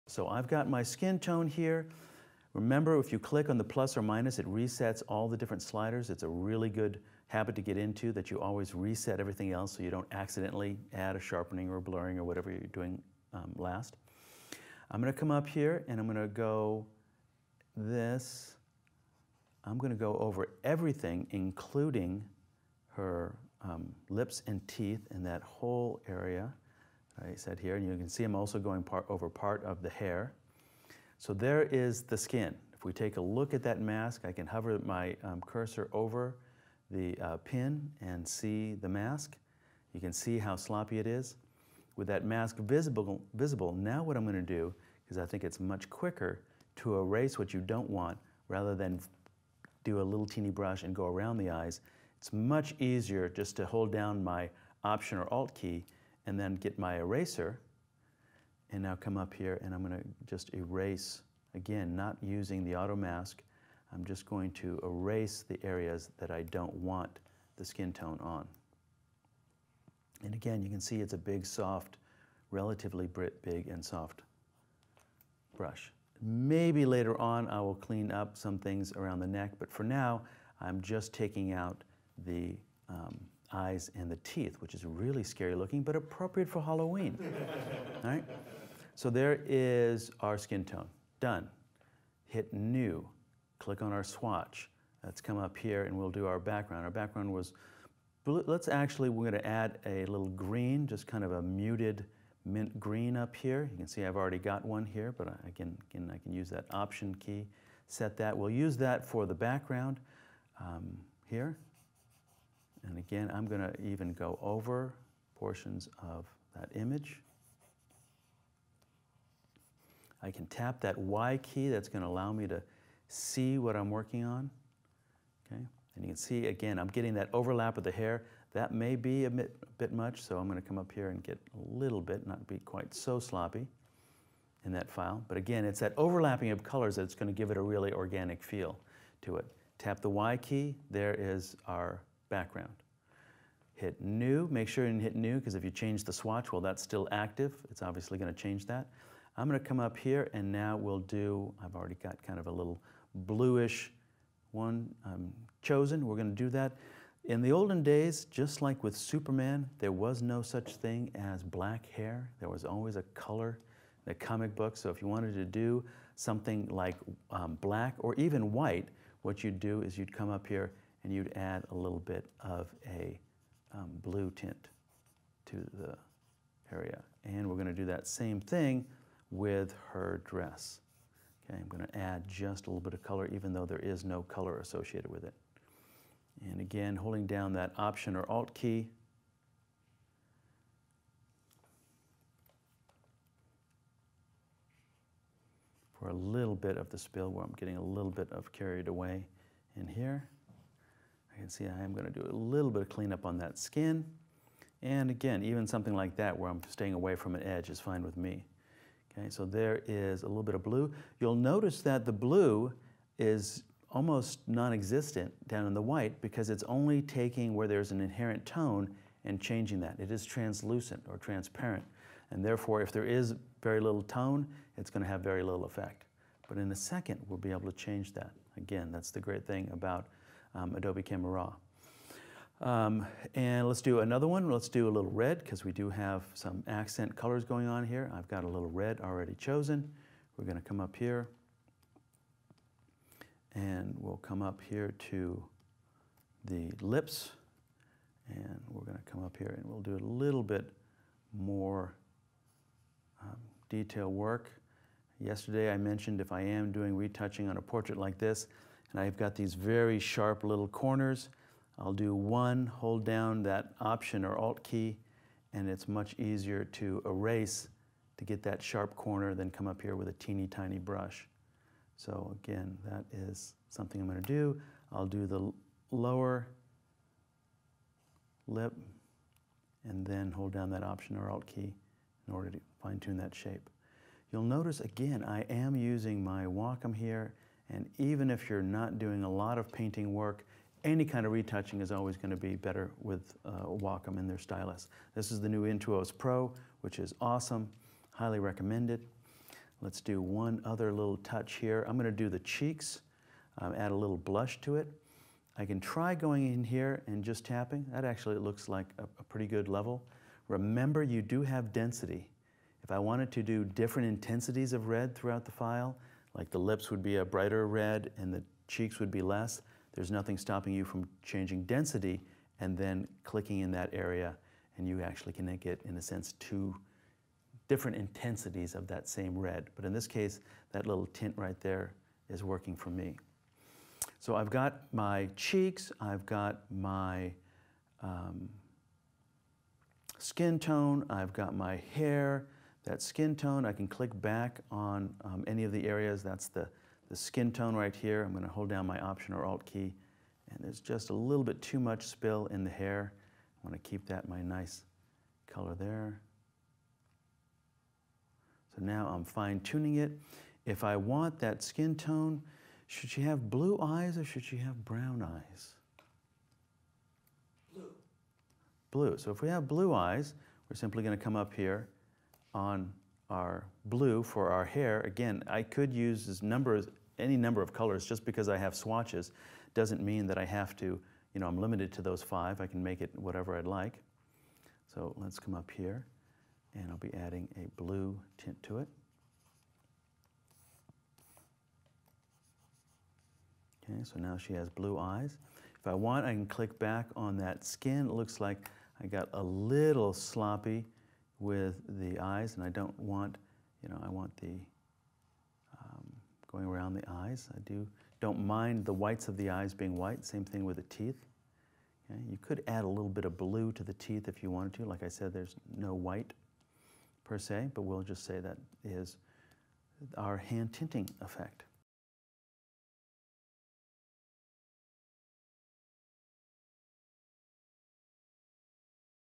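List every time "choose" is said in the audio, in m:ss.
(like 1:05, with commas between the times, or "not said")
not said.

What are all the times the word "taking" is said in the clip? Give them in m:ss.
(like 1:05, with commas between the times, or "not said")
1:21, 3:37.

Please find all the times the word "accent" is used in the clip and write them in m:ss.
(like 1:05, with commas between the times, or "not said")
3:56.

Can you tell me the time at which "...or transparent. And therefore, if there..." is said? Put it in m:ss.
3:41.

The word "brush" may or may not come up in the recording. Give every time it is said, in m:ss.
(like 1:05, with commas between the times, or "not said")
0:50, 1:15, 4:30.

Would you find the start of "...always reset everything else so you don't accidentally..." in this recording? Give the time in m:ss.
0:08.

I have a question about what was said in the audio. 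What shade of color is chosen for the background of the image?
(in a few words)
muted mint green.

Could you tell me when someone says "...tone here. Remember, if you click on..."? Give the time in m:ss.
0:01.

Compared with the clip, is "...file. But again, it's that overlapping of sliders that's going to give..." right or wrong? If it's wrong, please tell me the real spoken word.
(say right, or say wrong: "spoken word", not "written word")
wrong: "colors", not "sliders".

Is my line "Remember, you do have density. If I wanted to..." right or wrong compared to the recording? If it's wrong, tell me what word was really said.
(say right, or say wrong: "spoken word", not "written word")
right.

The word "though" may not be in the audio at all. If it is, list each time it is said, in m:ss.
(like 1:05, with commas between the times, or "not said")
3:03.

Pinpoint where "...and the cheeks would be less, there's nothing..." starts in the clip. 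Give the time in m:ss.
5:18.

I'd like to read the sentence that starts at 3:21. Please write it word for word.
I can see I am going to do a little bit of cleanup on that skin.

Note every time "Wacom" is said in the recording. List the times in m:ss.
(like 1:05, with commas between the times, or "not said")
4:46, 4:53.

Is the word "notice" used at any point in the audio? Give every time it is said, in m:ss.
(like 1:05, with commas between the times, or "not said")
3:31, 4:44.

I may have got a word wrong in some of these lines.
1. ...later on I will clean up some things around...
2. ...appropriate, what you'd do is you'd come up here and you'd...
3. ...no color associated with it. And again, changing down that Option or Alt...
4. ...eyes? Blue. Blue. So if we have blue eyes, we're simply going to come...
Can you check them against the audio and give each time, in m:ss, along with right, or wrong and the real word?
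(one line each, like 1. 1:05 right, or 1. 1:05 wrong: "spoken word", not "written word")
1. 1:16 right
2. 2:48 wrong: "white", not "appropriate"
3. 3:04 wrong: "holding", not "changing"
4. 6:05 right.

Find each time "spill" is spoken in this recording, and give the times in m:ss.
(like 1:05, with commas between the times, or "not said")
3:16, 5:52.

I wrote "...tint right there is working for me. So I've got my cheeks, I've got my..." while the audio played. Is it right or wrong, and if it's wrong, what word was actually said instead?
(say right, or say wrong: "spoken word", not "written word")
right.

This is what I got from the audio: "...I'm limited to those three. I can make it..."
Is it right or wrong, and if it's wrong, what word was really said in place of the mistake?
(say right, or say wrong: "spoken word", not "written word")
wrong: "five", not "three".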